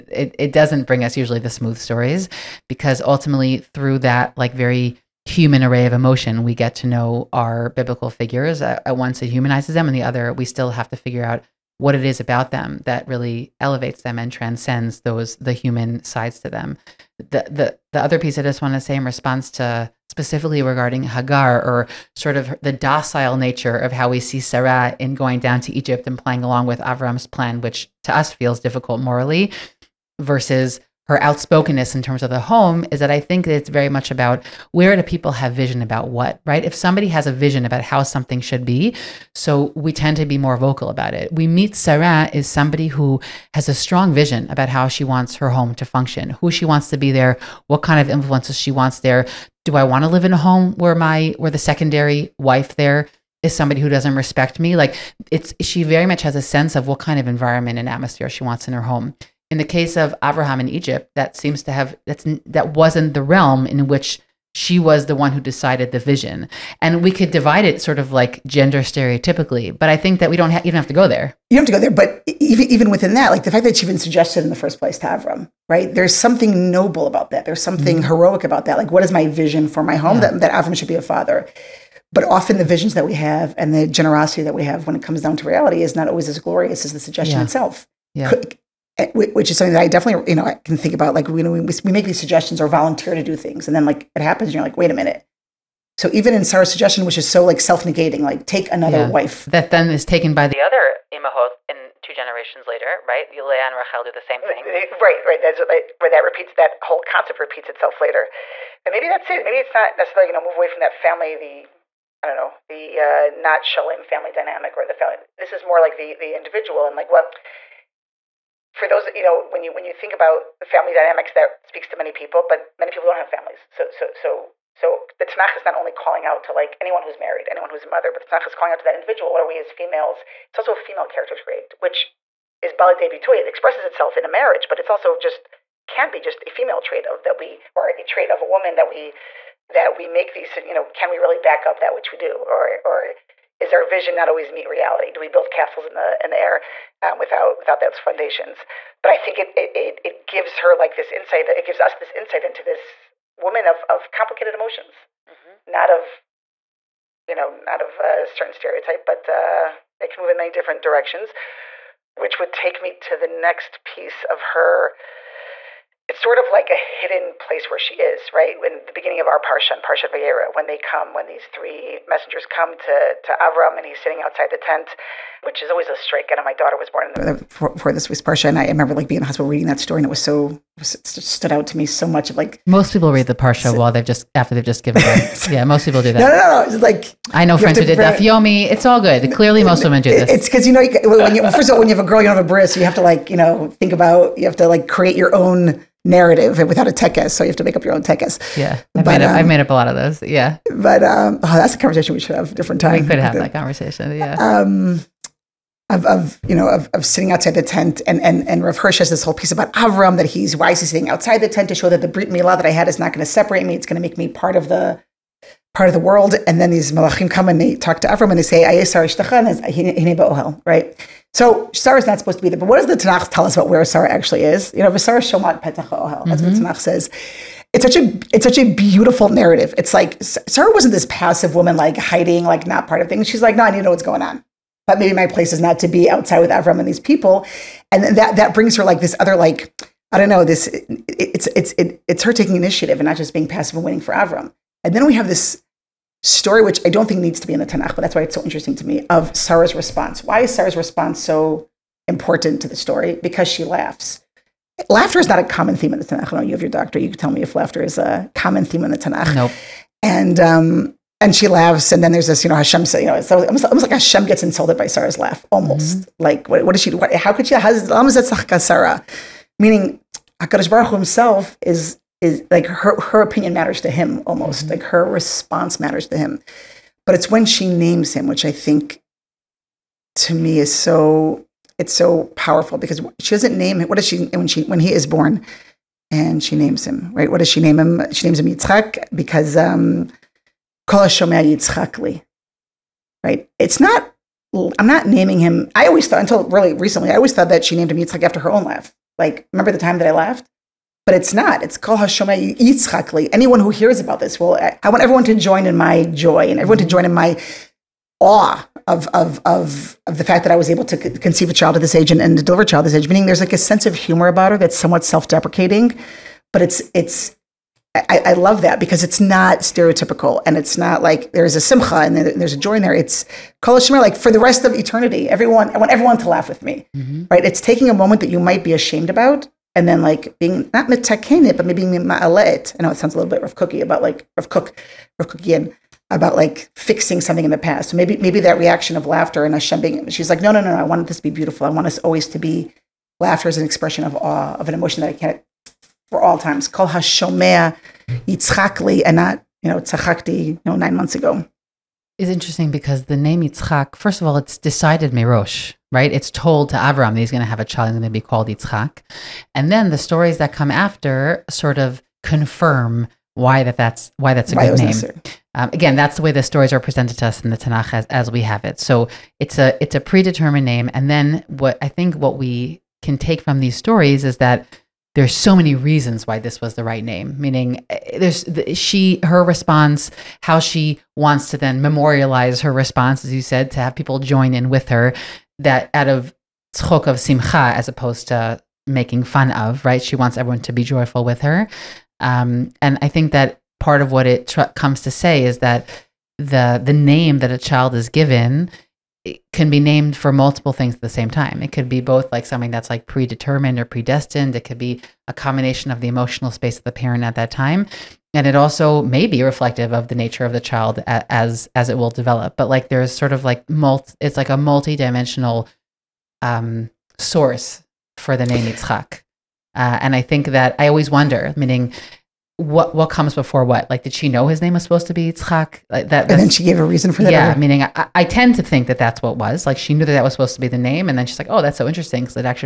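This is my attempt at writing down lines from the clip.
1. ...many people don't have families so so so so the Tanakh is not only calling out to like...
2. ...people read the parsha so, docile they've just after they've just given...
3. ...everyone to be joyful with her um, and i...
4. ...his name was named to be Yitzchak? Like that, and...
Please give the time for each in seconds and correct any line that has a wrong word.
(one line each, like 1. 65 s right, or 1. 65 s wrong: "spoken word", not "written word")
1. 122 s right
2. 182 s wrong: "while", not "docile"
3. 390 s right
4. 424 s wrong: "supposed", not "named".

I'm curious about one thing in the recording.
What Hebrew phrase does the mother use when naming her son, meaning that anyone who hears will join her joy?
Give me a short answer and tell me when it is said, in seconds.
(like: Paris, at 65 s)
Kol Hashomay Yitzchakli, at 301 s.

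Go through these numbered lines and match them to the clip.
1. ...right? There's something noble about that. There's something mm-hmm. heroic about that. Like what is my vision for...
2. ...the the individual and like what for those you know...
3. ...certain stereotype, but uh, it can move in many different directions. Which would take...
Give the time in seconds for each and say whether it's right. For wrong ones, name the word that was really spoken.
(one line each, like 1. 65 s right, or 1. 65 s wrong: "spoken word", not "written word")
1. 75 s right
2. 115 s right
3. 158 s right.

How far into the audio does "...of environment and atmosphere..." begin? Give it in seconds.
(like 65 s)
57 s.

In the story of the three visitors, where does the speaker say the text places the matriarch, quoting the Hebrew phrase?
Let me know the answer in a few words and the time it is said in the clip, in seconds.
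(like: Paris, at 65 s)
Petach Ohel, at 225 s.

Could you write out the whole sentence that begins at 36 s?
If somebody has a vision about how something should be, so we tend to be more vocal about it.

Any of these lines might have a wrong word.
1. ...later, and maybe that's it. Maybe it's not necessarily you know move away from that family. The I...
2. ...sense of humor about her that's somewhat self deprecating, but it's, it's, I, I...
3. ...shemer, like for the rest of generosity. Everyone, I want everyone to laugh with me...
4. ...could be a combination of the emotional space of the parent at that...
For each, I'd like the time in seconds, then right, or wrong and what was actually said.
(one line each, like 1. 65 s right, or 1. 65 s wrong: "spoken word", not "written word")
1. 108 s right
2. 313 s right
3. 323 s wrong: "eternity", not "generosity"
4. 404 s right.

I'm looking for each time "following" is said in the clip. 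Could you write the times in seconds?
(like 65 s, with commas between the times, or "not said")
not said.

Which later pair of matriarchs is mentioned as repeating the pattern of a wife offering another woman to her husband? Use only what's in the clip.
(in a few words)
Leah and Rachel.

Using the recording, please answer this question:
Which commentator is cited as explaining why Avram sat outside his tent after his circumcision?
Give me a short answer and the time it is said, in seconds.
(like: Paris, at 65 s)
Rav Hirsch, at 208 s.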